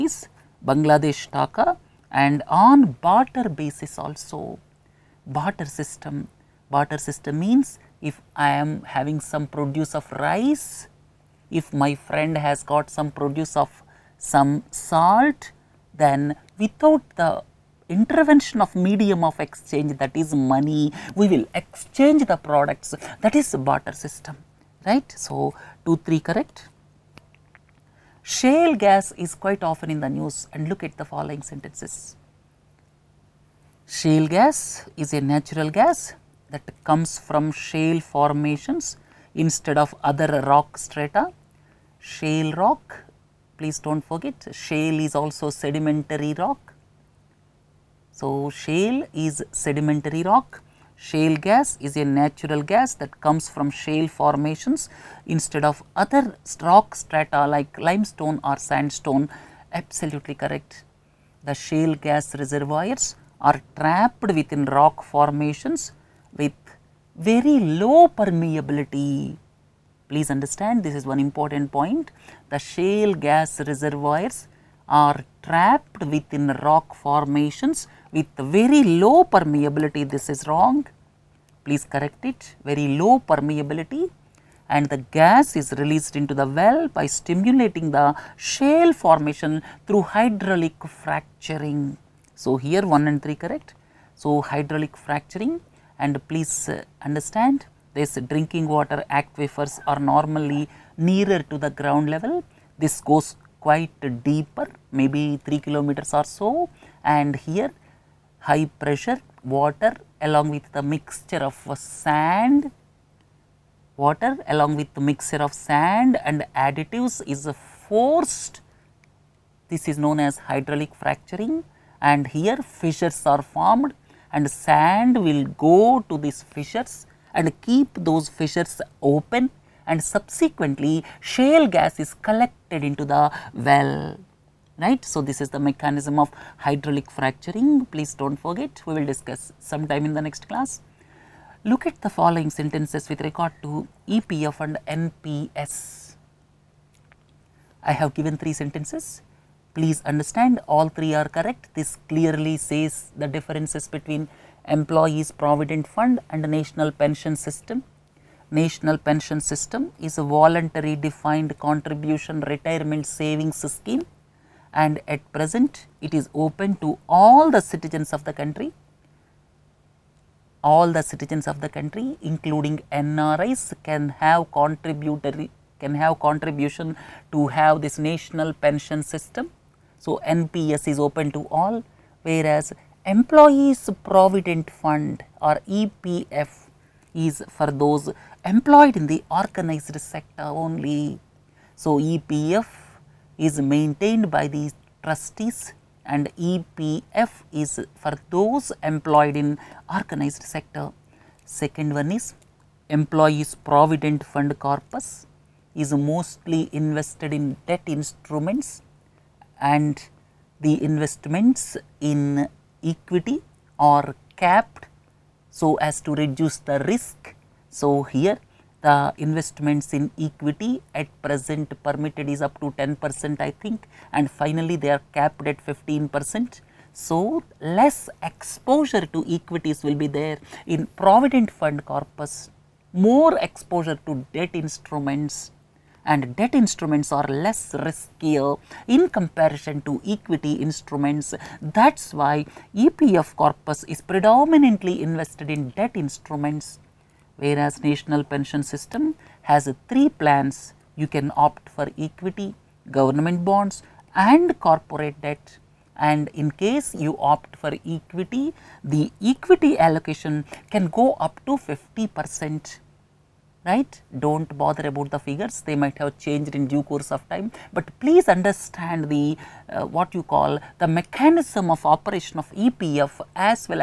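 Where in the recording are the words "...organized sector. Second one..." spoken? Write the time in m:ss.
3:19.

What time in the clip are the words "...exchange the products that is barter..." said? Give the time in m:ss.
0:21.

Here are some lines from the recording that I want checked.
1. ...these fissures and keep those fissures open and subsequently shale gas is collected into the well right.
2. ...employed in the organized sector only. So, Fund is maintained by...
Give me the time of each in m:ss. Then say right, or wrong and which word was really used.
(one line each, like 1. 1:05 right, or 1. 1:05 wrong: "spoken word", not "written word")
1. 2:06 right
2. 3:08 wrong: "EPF", not "Fund".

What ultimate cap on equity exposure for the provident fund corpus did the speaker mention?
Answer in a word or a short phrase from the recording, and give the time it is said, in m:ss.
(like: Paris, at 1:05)
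15 percent, at 3:45.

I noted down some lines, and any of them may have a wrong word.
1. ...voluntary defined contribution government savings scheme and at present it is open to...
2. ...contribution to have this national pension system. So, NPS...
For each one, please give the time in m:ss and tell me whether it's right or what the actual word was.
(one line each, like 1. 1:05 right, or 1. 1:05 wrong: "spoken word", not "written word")
1. 2:40 wrong: "retirement", not "government"
2. 2:56 right.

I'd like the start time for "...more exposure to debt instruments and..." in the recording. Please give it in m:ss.
3:52.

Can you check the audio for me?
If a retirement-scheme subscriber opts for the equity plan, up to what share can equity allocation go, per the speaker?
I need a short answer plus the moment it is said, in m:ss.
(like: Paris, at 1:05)
50 percent, at 4:21.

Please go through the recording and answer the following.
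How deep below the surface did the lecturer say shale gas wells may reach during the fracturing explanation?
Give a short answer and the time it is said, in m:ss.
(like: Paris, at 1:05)
3 kilometers, at 1:45.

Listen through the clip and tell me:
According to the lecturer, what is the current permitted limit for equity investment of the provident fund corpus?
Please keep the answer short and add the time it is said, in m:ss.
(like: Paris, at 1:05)
10 percent, at 3:42.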